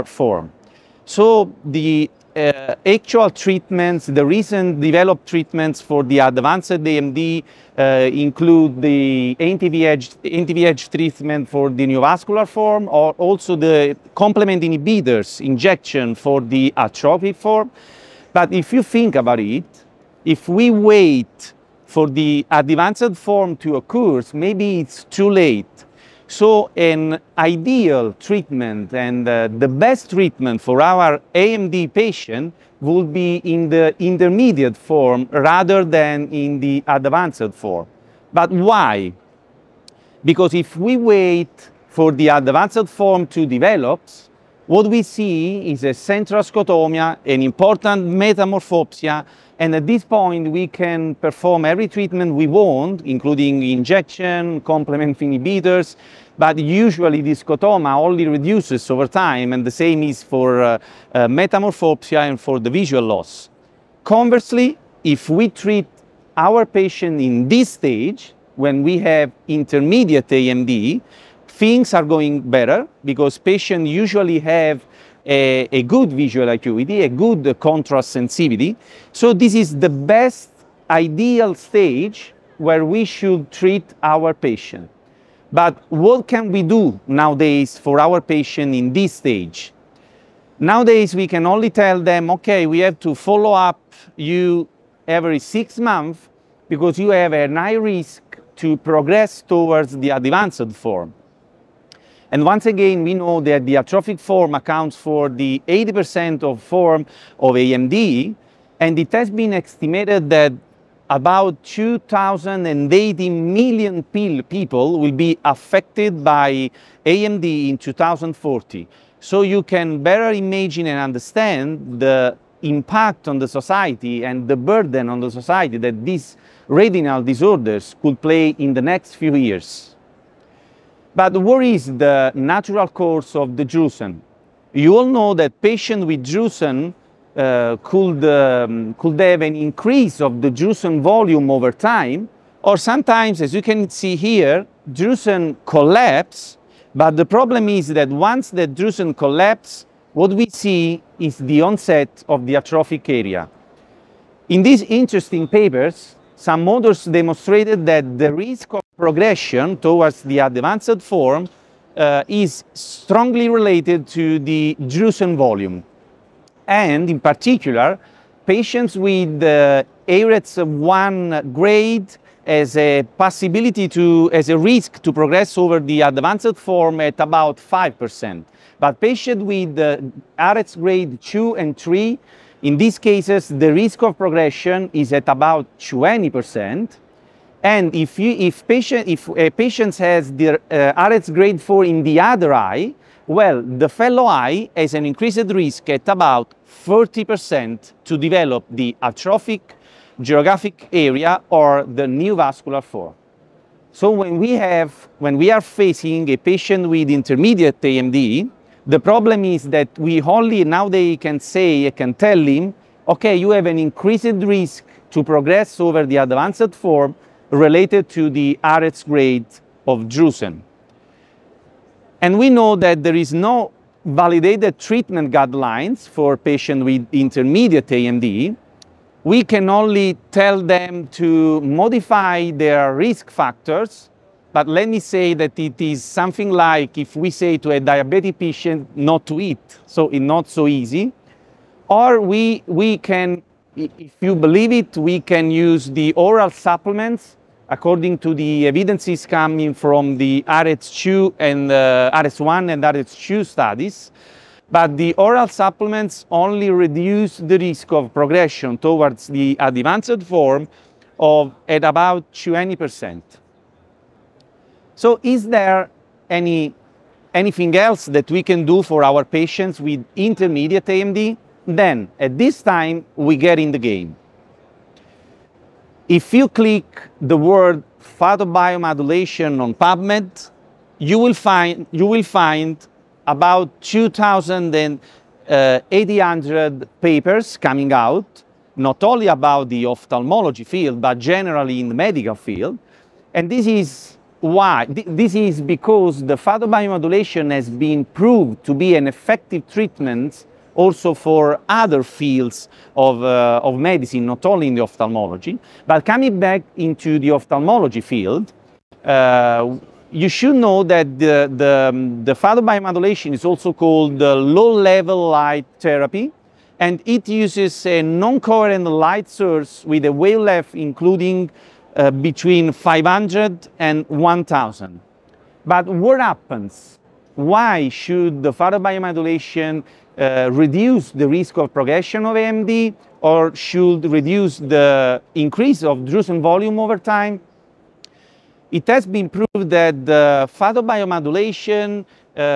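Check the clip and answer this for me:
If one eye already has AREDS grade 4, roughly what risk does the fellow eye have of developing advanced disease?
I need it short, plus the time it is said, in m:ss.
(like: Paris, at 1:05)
40%, at 3:16.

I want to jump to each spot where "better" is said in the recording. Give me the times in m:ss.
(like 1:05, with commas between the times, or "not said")
1:12, 2:00.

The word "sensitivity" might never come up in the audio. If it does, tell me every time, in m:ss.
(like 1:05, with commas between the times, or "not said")
1:18.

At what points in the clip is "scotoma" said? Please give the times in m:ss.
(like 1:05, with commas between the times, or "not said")
0:46, 0:57.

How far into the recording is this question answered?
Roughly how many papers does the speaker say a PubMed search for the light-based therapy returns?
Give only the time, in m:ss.
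4:43.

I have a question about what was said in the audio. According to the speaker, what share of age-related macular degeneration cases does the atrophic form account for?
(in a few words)
80%.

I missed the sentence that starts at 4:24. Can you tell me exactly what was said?
So is there any, anything else that we can do for our patients with intermediate AMD?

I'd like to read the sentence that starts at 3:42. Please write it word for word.
And we know that there is no validated treatment guidelines for patients with intermediate AMD.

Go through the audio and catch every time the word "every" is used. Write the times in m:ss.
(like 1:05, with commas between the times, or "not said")
0:51, 1:35.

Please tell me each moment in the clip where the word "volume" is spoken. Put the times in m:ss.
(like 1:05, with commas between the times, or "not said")
2:21, 2:45, 5:36.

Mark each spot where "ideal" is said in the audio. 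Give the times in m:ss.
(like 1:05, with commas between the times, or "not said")
0:27, 1:20.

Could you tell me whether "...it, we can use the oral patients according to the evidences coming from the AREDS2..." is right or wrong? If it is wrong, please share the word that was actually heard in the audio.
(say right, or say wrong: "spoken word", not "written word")
wrong: "supplements", not "patients".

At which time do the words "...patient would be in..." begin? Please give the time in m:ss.
0:31.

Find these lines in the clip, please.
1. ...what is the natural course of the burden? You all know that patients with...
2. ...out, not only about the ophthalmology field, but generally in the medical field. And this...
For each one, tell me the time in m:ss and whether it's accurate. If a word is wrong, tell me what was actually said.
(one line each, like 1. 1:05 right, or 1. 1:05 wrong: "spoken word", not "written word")
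1. 2:11 wrong: "drusen", not "burden"
2. 4:47 right.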